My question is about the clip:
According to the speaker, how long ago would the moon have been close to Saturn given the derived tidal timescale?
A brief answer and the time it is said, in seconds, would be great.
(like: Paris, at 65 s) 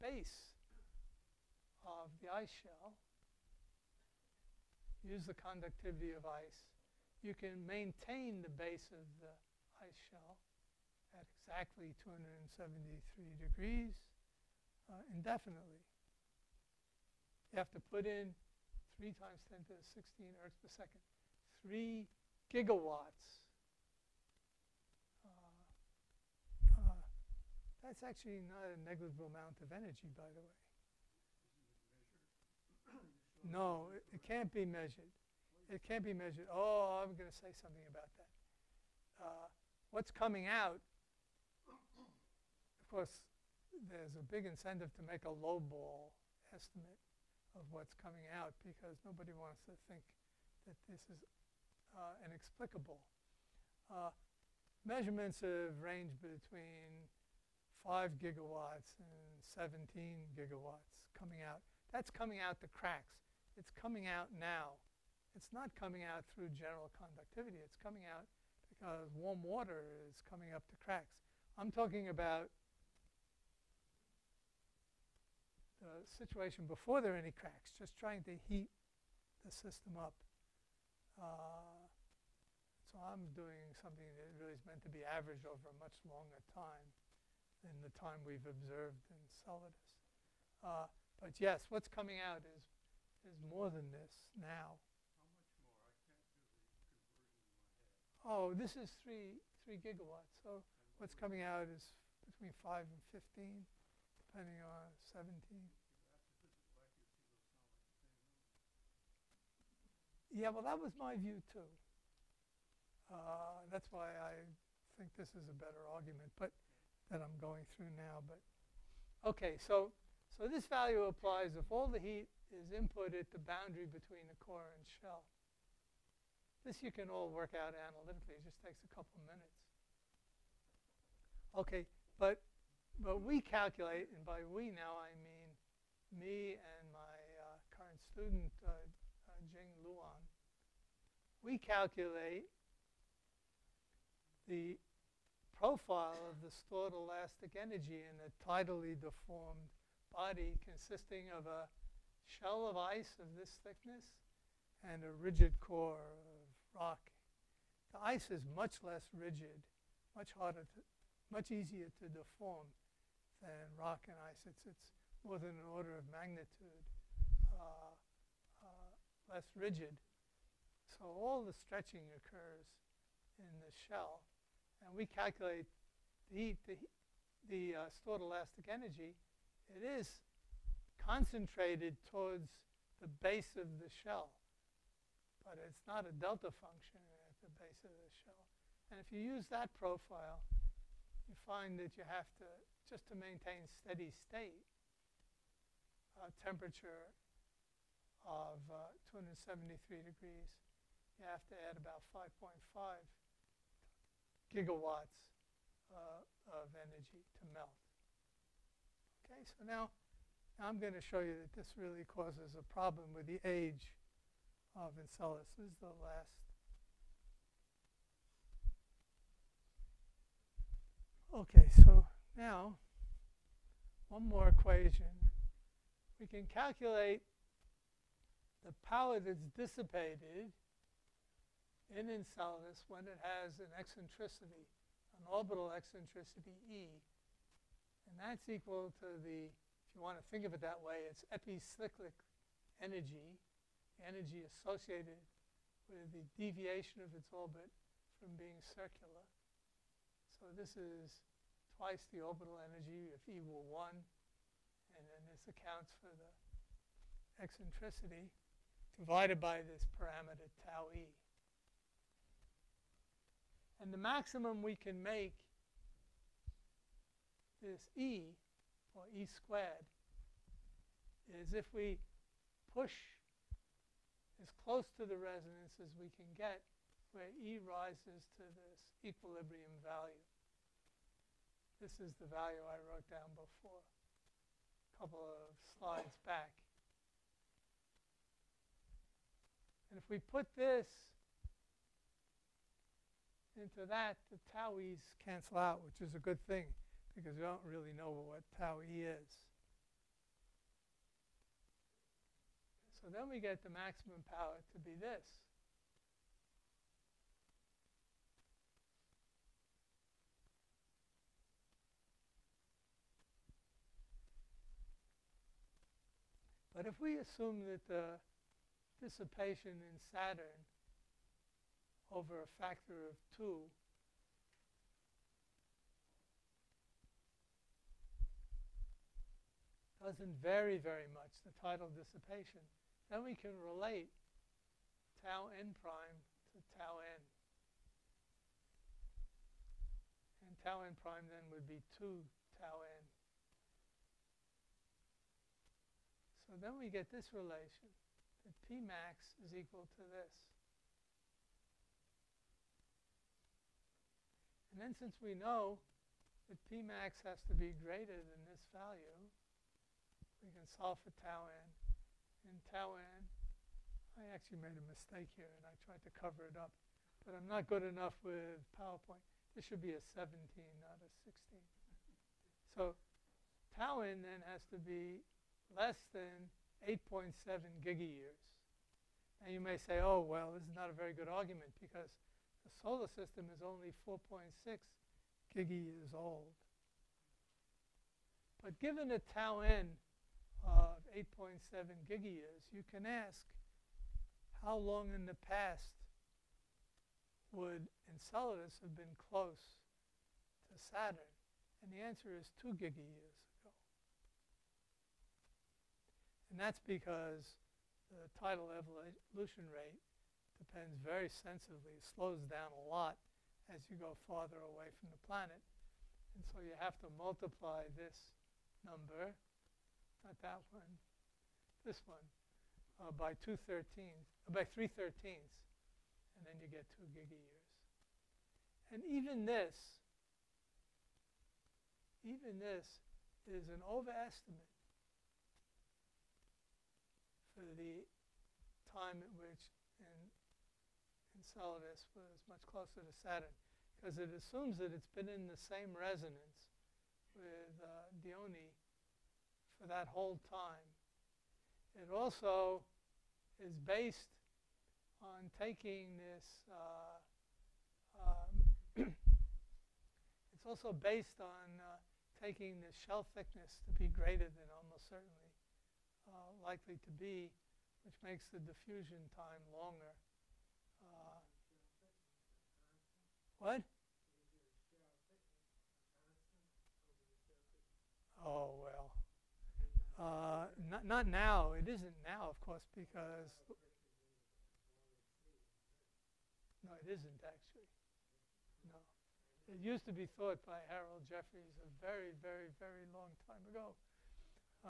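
2 gigayears, at 402 s.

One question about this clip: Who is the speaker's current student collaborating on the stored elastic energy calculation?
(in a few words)
Jing Luan.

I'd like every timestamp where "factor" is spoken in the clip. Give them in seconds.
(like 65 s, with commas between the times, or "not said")
322 s.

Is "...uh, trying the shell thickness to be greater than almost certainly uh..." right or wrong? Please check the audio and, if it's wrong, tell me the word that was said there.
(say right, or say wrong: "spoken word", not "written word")
wrong: "taking", not "trying".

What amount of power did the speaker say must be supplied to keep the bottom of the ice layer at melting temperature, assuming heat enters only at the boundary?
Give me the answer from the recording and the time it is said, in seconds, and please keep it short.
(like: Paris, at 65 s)
3 gigawatts, at 21 s.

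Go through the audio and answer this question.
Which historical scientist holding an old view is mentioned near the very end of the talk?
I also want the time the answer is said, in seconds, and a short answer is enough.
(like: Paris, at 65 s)
Harold Jeffreys, at 490 s.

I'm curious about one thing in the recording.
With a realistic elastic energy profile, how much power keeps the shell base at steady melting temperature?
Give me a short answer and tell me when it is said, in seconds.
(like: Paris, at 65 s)
5.5 gigawatts, at 202 s.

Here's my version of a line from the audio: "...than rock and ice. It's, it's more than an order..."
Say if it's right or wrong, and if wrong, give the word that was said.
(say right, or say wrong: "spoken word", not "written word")
right.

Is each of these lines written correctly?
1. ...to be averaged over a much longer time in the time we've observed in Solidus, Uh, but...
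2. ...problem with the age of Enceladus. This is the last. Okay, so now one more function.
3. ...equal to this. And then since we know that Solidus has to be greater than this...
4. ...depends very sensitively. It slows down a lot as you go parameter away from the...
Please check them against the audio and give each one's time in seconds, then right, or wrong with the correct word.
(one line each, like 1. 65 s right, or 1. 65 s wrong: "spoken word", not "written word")
1. 84 s right
2. 212 s wrong: "equation", not "function"
3. 349 s wrong: "Pmax", not "Solidus"
4. 410 s wrong: "farther", not "parameter".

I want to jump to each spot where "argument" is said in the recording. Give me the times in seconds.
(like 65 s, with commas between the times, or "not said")
115 s, 381 s.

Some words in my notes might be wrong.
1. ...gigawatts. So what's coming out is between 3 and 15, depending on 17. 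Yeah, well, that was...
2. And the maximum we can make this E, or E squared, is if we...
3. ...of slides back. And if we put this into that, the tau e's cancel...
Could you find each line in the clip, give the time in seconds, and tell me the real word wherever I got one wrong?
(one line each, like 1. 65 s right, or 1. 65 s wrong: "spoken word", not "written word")
1. 99 s wrong: "5", not "3"
2. 263 s right
3. 285 s right.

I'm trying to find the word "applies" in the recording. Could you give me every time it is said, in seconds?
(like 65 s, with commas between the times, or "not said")
121 s.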